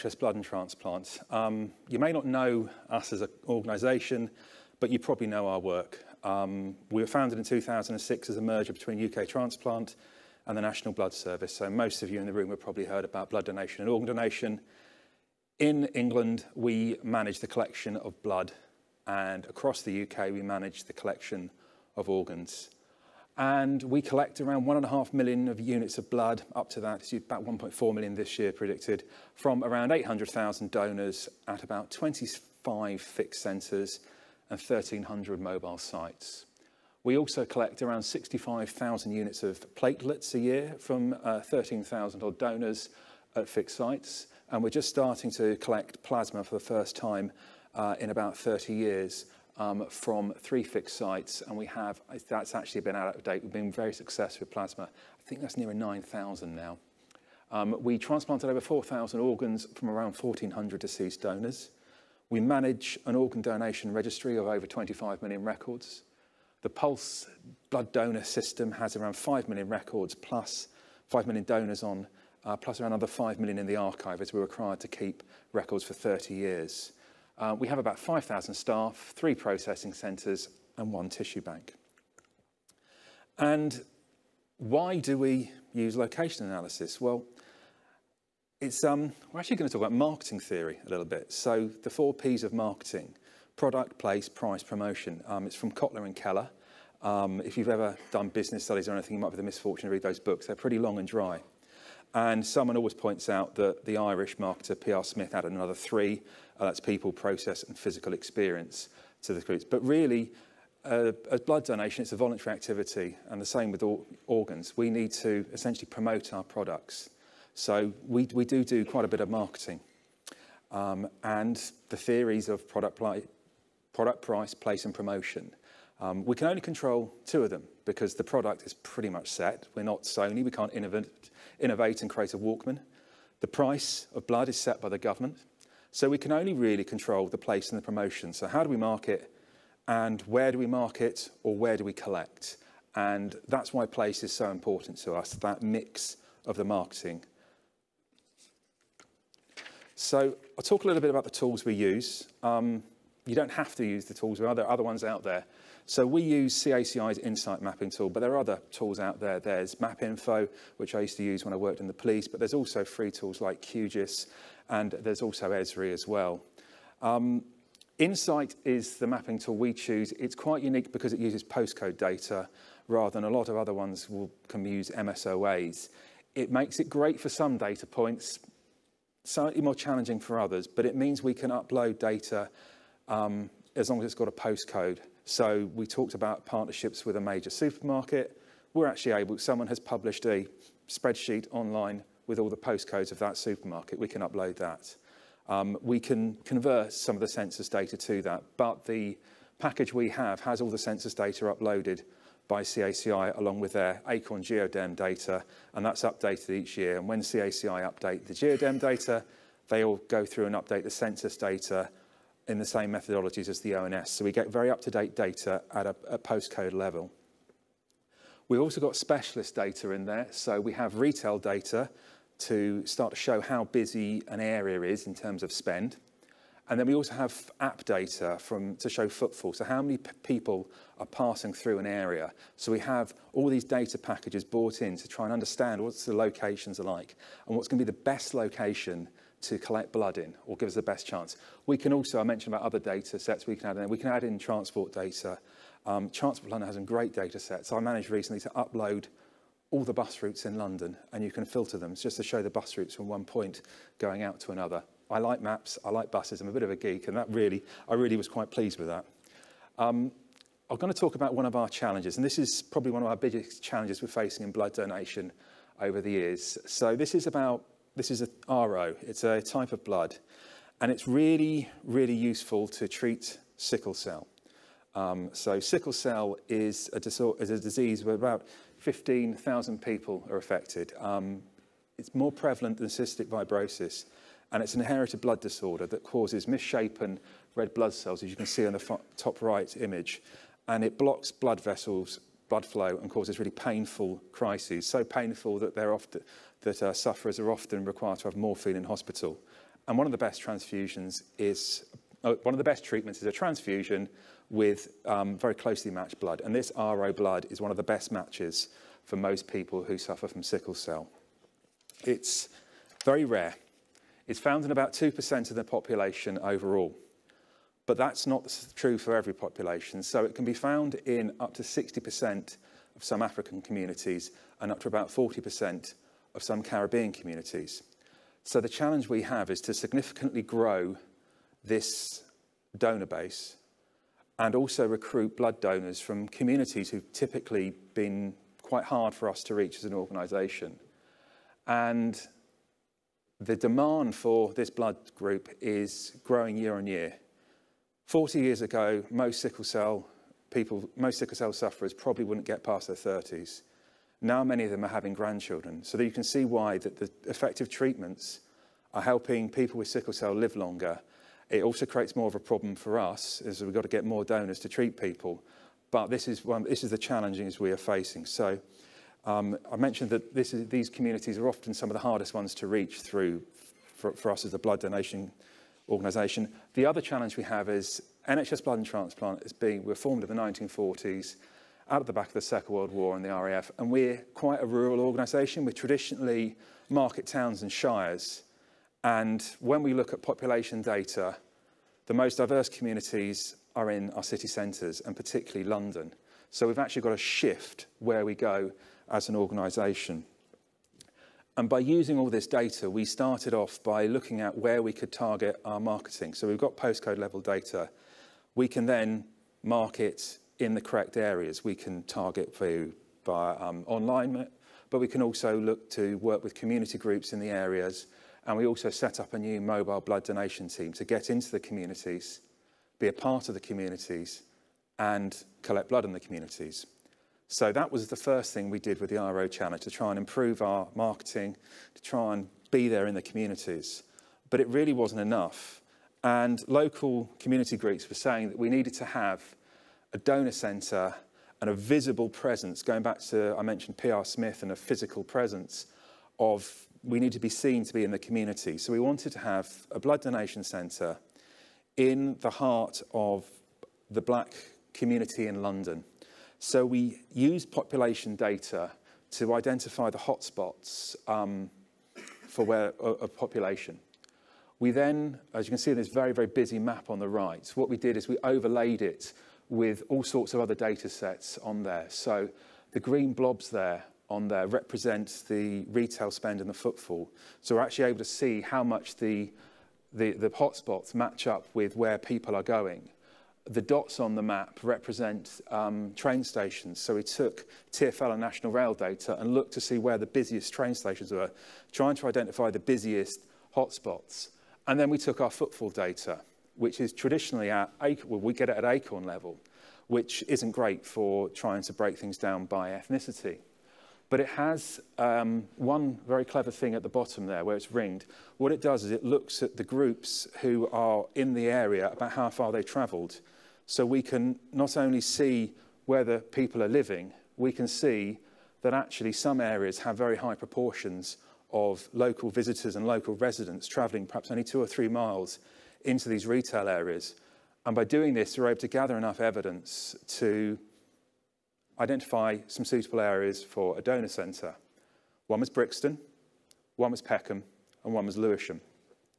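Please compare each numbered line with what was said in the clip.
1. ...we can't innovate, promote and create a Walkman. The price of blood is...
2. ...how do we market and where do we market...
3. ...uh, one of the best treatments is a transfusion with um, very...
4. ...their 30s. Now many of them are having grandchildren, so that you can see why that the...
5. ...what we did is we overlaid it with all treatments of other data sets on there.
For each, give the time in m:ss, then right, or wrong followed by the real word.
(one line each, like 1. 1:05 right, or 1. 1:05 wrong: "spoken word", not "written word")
1. 2:10 wrong: "innovate", not "promote"
2. 2:18 right
3. 5:02 right
4. 5:52 right
5. 7:47 wrong: "sorts", not "treatments".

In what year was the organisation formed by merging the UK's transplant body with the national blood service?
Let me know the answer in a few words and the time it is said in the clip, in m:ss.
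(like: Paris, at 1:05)
2006, at 0:07.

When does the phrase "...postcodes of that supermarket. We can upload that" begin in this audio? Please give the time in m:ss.
3:12.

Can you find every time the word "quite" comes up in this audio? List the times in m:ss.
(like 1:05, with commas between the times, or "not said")
1:58, 2:50, 4:18, 5:38, 6:24.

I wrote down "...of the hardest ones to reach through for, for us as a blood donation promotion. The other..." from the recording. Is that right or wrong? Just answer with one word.
wrong.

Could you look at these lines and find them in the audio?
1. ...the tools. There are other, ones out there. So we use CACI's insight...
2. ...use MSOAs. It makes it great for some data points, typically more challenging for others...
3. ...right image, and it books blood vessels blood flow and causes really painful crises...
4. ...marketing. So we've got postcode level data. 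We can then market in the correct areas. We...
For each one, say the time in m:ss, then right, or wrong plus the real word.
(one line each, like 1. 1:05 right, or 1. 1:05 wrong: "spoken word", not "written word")
1. 2:34 right
2. 2:54 wrong: "slightly", not "typically"
3. 4:49 wrong: "blocks", not "books"
4. 6:45 right.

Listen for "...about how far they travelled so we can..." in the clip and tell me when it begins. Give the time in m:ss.
8:32.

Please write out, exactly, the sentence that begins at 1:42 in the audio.
And someone always points out that the Irish marketer P.R.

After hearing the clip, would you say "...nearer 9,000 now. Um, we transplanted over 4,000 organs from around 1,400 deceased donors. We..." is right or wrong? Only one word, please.
right.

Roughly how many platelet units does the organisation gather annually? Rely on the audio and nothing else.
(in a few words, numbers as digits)
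65,000.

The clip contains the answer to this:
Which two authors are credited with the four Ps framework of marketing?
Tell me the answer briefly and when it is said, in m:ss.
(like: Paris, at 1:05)
Kotler and Keller, at 1:35.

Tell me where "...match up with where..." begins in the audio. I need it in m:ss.
8:01.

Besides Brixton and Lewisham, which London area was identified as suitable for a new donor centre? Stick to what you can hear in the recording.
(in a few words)
Peckham.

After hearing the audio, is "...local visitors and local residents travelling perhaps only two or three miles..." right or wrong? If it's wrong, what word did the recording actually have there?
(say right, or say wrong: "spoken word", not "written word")
right.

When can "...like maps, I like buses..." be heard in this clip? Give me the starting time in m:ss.
4:15.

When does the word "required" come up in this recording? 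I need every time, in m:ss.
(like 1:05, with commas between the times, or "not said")
1:14, 4:57.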